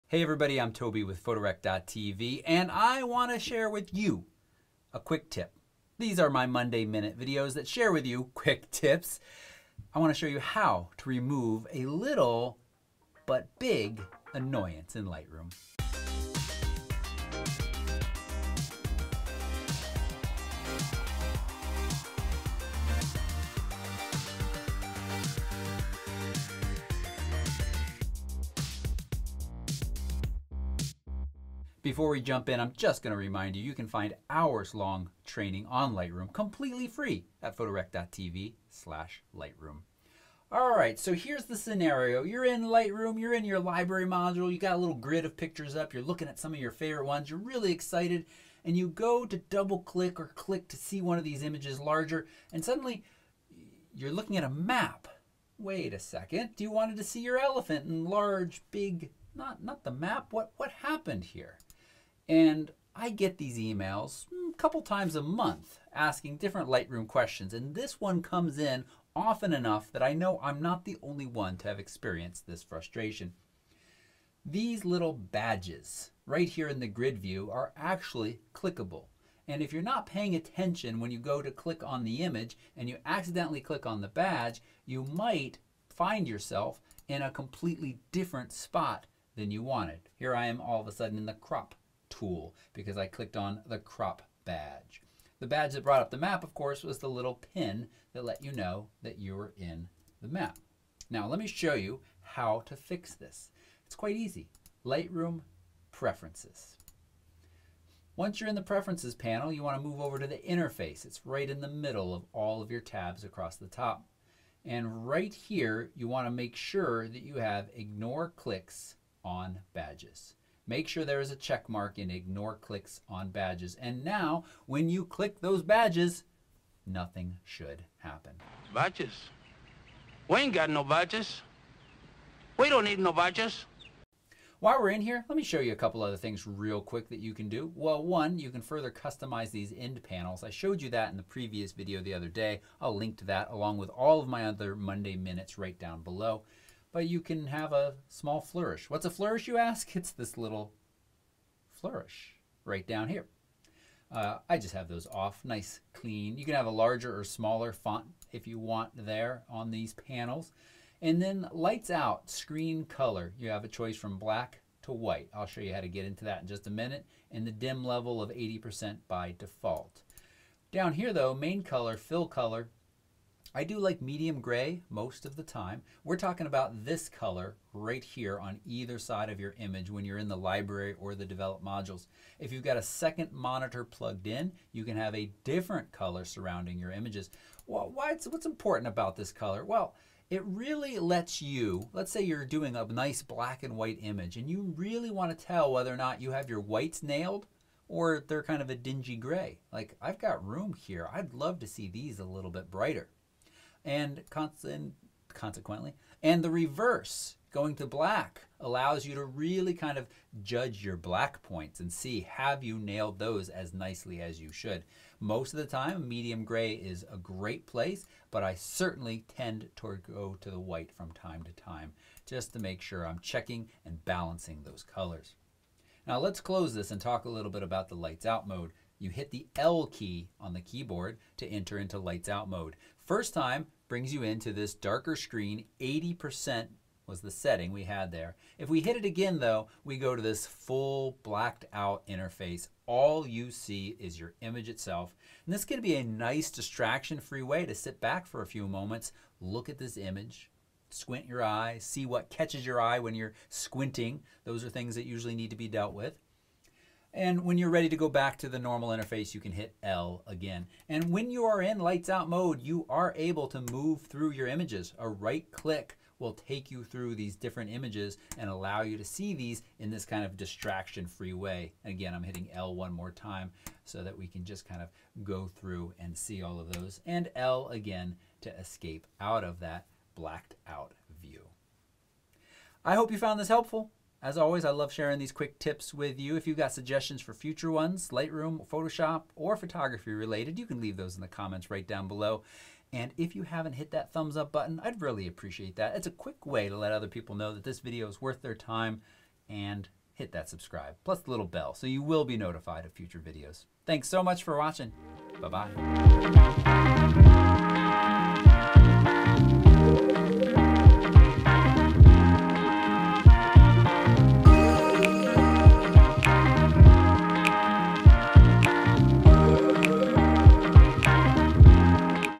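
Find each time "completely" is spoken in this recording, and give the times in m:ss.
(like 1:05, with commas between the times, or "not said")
0:36, 1:27.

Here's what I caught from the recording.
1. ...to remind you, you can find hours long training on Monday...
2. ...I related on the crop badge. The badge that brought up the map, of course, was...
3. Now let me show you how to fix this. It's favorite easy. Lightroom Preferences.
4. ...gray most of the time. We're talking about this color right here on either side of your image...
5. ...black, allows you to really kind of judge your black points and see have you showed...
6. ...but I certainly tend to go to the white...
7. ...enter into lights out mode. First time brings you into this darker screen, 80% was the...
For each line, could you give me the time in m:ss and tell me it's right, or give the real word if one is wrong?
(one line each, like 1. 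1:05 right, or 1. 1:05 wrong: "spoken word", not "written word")
1. 0:33 wrong: "Lightroom", not "Monday"
2. 1:32 wrong: "clicked", not "related"
3. 1:41 wrong: "quite", not "favorite"
4. 2:54 right
5. 3:27 wrong: "nailed", not "showed"
6. 3:38 right
7. 3:51 right.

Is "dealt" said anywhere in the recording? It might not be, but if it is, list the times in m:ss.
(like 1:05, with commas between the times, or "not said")
4:15.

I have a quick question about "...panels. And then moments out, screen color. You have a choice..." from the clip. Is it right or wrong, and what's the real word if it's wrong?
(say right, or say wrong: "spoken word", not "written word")
wrong: "lights", not "moments".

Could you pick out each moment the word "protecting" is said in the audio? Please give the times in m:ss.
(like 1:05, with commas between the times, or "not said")
not said.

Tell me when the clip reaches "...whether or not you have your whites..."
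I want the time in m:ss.
3:15.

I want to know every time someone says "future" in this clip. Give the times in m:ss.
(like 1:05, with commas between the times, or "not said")
4:47, 5:02.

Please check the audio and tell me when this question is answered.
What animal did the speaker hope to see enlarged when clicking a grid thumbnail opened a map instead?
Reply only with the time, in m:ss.
0:57.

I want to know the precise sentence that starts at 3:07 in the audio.
Well, why what's important about this color?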